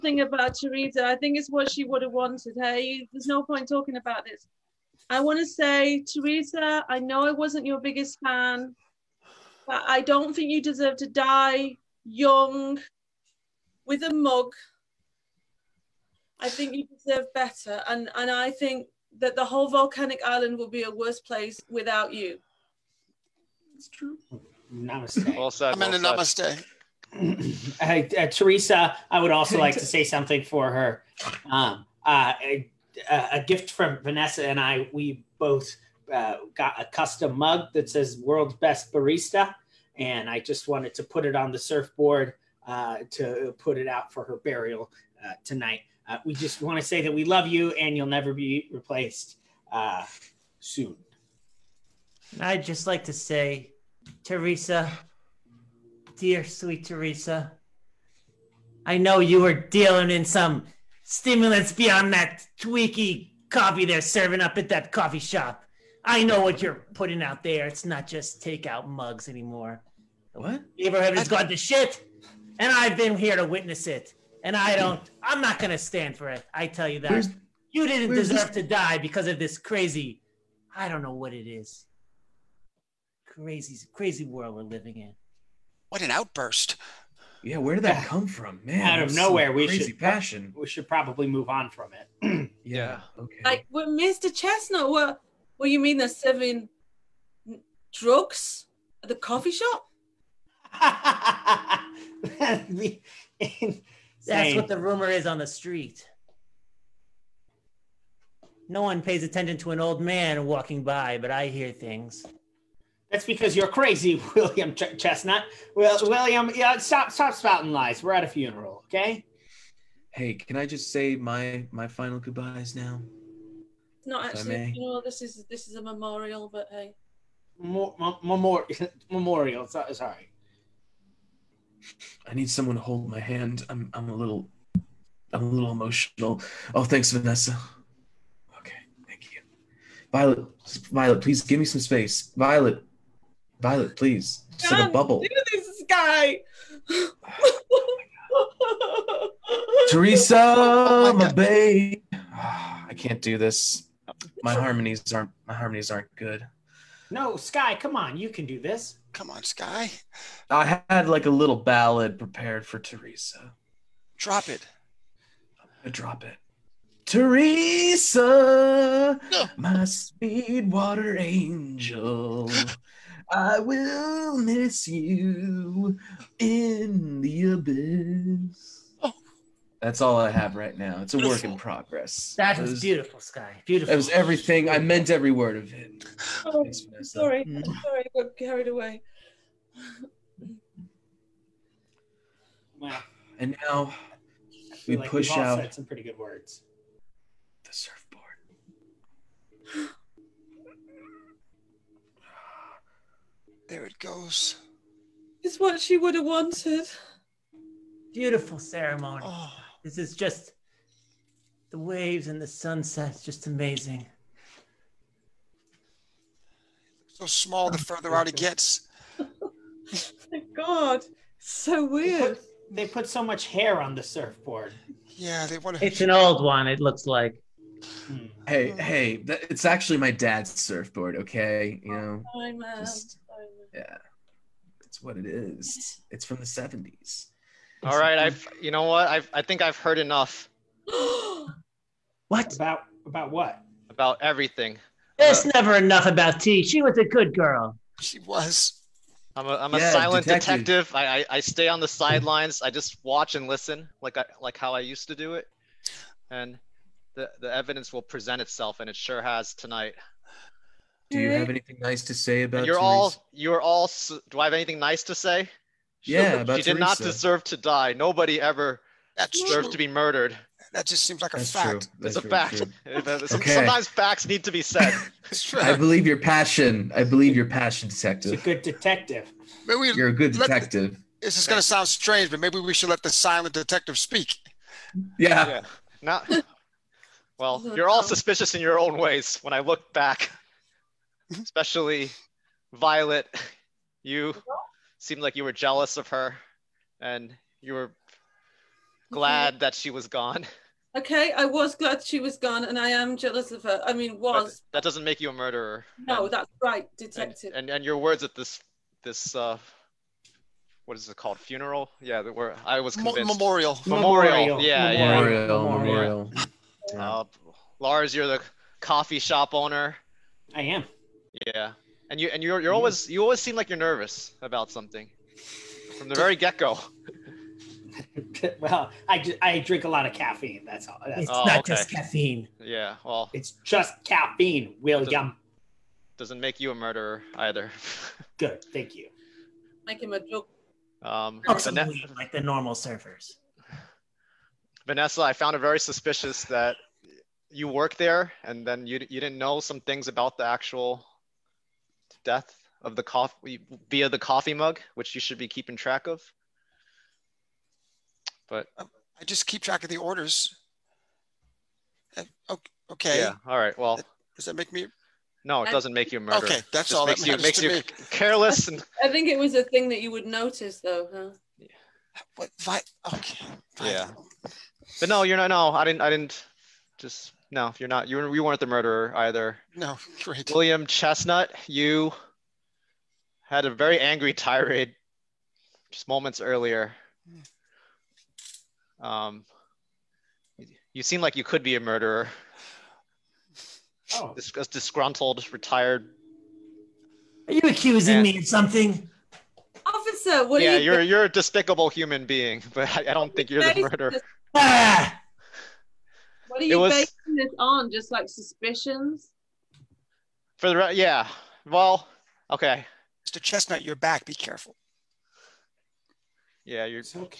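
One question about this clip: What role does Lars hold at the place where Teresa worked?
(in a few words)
Coffee shop owner.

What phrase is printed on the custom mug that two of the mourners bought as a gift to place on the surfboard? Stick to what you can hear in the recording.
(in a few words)
World's Best Barista.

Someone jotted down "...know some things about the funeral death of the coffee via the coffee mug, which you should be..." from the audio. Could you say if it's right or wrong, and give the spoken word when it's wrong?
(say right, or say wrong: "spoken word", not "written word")
wrong: "actual", not "funeral".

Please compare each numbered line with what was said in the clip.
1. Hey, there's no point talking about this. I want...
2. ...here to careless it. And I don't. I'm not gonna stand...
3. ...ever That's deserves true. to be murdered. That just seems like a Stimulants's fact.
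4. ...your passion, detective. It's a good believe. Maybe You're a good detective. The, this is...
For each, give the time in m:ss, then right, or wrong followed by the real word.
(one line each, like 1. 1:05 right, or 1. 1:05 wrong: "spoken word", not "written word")
1. 0:02 right
2. 1:13 wrong: "witness", not "careless"
3. 4:28 wrong: "That", not "Stimulants"
4. 4:37 wrong: "detective", not "believe".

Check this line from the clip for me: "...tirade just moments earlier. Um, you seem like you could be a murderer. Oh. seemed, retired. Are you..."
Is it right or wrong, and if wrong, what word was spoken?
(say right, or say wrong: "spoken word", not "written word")
wrong: "disgruntled", not "seemed".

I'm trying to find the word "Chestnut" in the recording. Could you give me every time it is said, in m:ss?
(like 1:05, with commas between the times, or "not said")
1:34, 1:54, 6:20, 6:53.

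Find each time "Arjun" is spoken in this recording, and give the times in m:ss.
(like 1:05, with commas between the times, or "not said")
not said.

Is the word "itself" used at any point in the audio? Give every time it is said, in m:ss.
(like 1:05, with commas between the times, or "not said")
4:18.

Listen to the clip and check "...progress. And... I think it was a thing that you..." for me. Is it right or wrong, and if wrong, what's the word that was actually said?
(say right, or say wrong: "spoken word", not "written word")
wrong: "careless", not "progress".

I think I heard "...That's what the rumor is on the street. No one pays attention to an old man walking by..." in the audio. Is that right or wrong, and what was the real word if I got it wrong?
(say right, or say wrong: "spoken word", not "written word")
right.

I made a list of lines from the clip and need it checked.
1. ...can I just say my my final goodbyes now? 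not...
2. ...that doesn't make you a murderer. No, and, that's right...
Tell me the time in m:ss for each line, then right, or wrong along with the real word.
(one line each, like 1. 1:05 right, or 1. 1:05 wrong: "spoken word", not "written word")
1. 2:00 right
2. 5:04 right.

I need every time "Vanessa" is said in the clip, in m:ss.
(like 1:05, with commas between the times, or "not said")
0:34, 2:17, 5:44.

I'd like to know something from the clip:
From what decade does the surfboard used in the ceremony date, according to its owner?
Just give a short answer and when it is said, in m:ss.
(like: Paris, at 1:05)
The 70s, at 3:56.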